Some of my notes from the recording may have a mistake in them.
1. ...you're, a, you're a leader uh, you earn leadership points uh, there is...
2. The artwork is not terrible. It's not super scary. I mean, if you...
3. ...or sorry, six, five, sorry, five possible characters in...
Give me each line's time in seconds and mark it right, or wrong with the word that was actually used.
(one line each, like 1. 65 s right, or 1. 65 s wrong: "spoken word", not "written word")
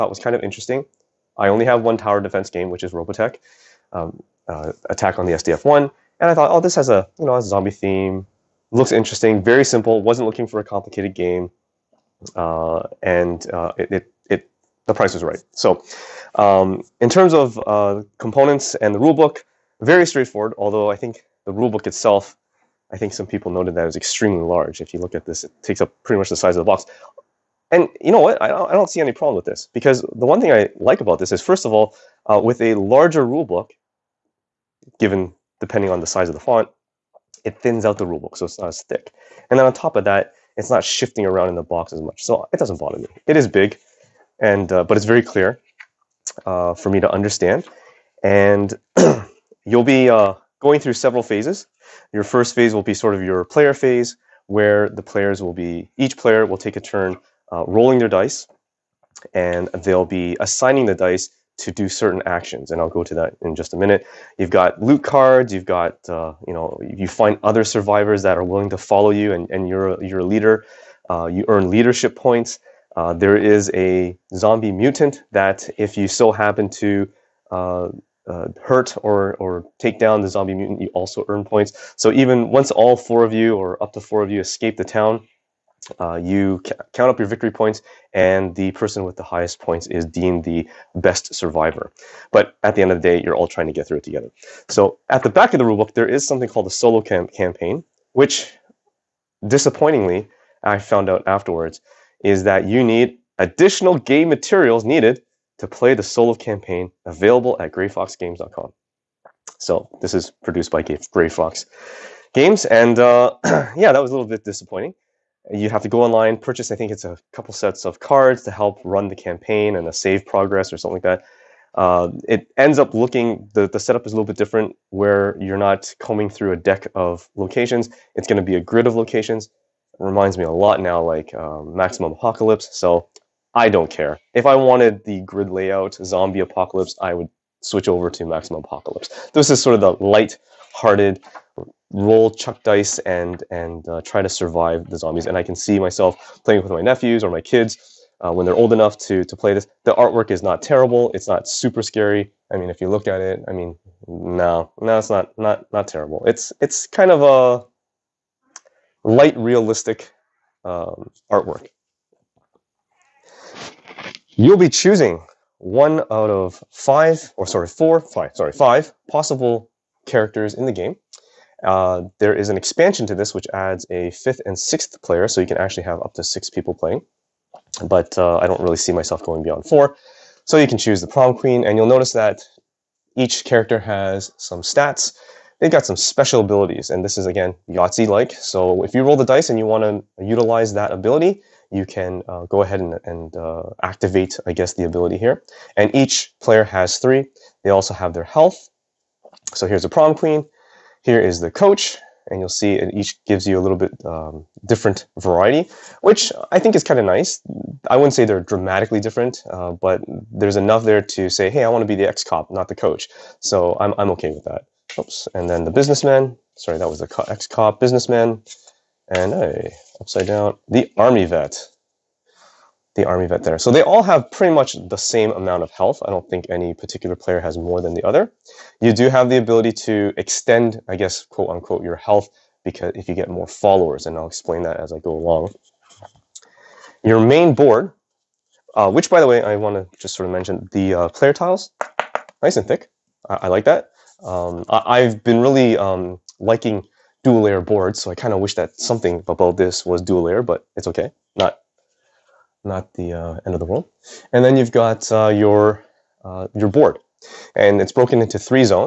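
1. 69 s right
2. 149 s right
3. 167 s wrong: "four", not "six".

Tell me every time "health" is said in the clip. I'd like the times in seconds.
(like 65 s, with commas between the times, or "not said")
198 s, 225 s, 231 s.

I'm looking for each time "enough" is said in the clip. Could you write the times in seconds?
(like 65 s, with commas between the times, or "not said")
148 s, 210 s.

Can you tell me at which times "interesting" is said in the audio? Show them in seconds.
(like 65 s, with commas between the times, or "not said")
0 s, 8 s.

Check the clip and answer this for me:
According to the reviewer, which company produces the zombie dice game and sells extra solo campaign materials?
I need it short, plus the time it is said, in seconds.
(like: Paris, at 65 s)
Gray Fox Games, at 111 s.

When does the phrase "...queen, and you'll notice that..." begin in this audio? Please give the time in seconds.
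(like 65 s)
181 s.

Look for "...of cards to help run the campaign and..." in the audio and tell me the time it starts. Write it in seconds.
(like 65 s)
117 s.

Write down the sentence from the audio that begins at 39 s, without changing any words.
And then on top of that, it's not shifting around in the box as much, so it doesn't bother me.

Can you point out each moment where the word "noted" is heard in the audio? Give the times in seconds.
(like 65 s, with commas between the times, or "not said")
23 s.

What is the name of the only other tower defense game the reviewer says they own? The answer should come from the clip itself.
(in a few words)
Robotech: Attack on the SDF-1.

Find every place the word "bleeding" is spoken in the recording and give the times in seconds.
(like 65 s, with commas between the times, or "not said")
not said.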